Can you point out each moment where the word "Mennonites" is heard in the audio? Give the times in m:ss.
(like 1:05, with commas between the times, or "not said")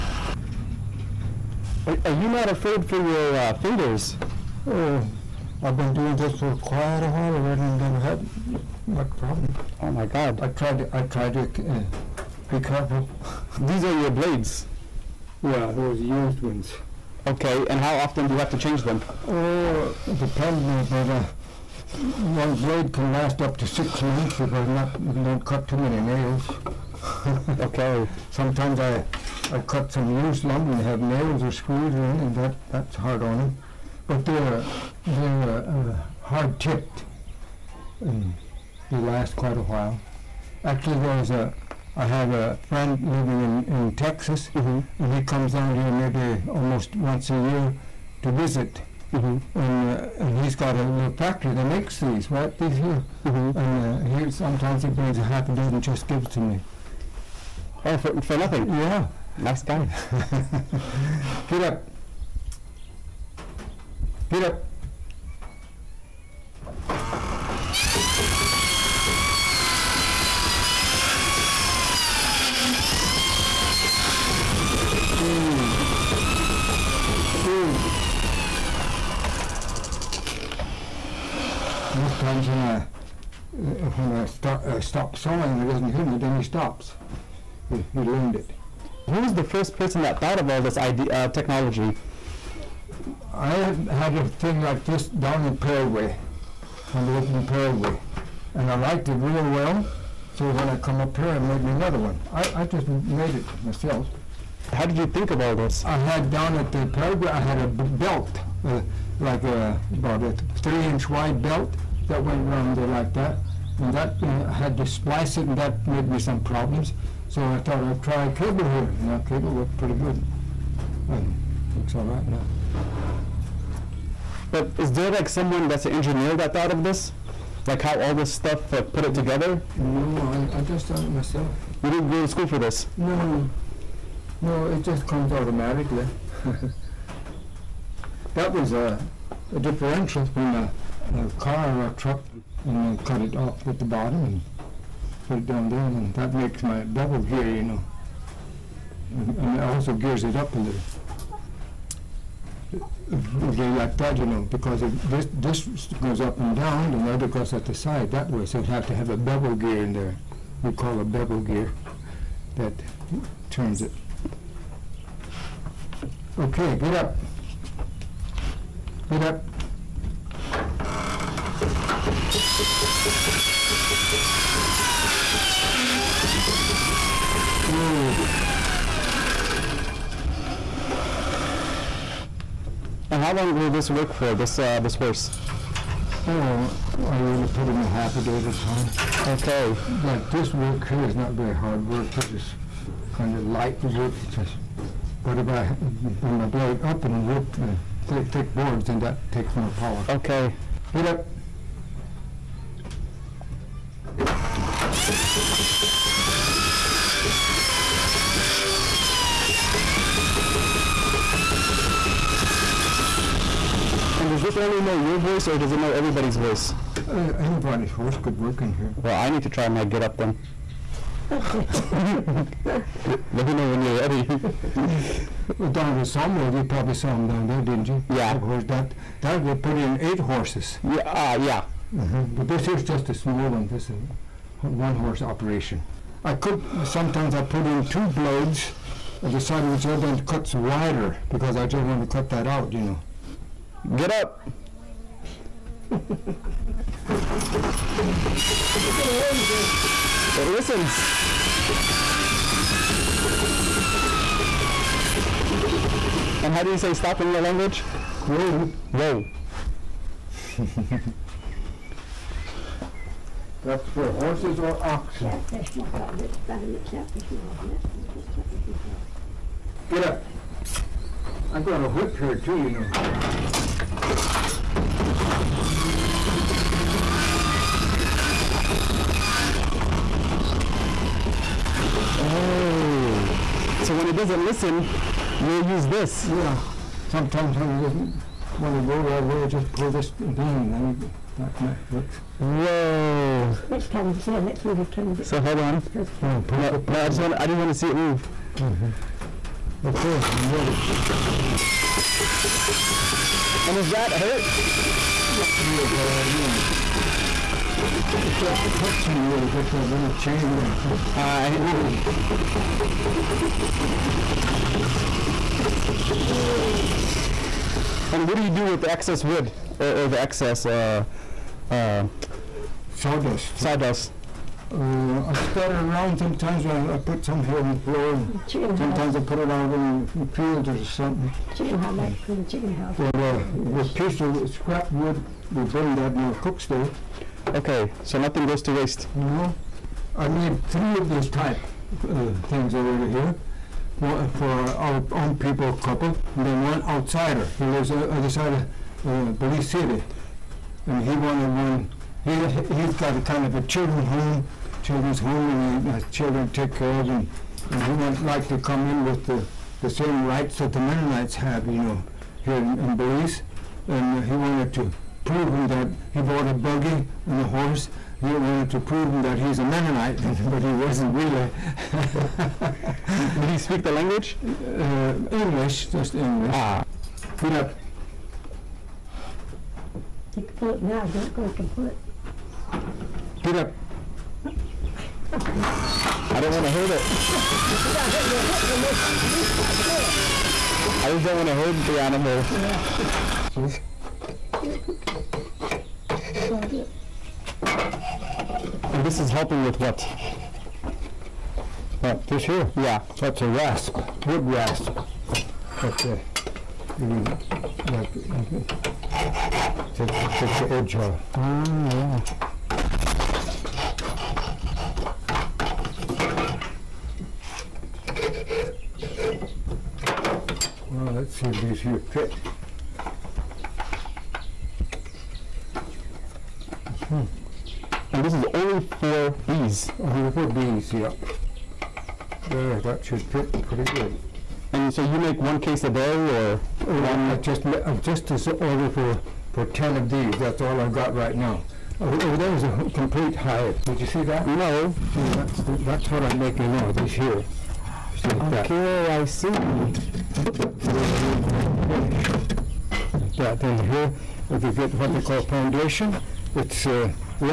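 6:00, 6:09.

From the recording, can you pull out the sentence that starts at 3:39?
Well, I need to try my get up then.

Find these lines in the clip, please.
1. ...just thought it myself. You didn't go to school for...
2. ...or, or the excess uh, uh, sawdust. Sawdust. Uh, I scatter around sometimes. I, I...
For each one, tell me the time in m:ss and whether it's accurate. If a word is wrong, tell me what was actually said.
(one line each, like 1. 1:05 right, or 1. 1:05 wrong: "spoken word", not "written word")
1. 2:10 right
2. 5:19 right.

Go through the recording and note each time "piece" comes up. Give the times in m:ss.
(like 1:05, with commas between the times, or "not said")
5:33.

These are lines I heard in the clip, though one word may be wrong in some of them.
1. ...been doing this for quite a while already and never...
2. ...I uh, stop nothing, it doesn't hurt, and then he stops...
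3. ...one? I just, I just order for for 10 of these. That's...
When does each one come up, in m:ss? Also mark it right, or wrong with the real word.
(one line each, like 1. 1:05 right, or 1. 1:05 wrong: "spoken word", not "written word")
1. 0:05 right
2. 1:24 wrong: "sawing", not "nothing"
3. 7:17 right.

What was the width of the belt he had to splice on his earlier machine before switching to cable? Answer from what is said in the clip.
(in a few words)
3 inches.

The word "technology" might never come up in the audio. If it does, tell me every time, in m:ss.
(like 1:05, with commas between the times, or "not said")
1:31.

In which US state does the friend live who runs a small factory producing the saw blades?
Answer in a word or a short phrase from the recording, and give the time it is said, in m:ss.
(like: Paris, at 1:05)
Texas, at 0:43.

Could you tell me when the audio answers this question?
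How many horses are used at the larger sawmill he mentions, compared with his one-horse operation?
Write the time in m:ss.
3:49.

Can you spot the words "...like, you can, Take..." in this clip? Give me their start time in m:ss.
6:47.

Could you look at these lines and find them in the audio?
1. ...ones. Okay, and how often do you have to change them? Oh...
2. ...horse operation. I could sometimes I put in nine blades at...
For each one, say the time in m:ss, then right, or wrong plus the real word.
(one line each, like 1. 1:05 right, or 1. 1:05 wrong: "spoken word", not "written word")
1. 0:16 right
2. 3:54 wrong: "two", not "nine".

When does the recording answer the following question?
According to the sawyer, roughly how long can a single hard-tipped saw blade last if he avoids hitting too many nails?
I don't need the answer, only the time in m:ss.
0:23.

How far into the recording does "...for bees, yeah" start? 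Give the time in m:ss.
7:10.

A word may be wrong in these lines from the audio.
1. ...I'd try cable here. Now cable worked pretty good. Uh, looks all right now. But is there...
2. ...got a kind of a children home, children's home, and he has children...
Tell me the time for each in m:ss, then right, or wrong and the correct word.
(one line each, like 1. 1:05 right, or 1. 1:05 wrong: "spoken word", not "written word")
1. 1:57 right
2. 5:52 right.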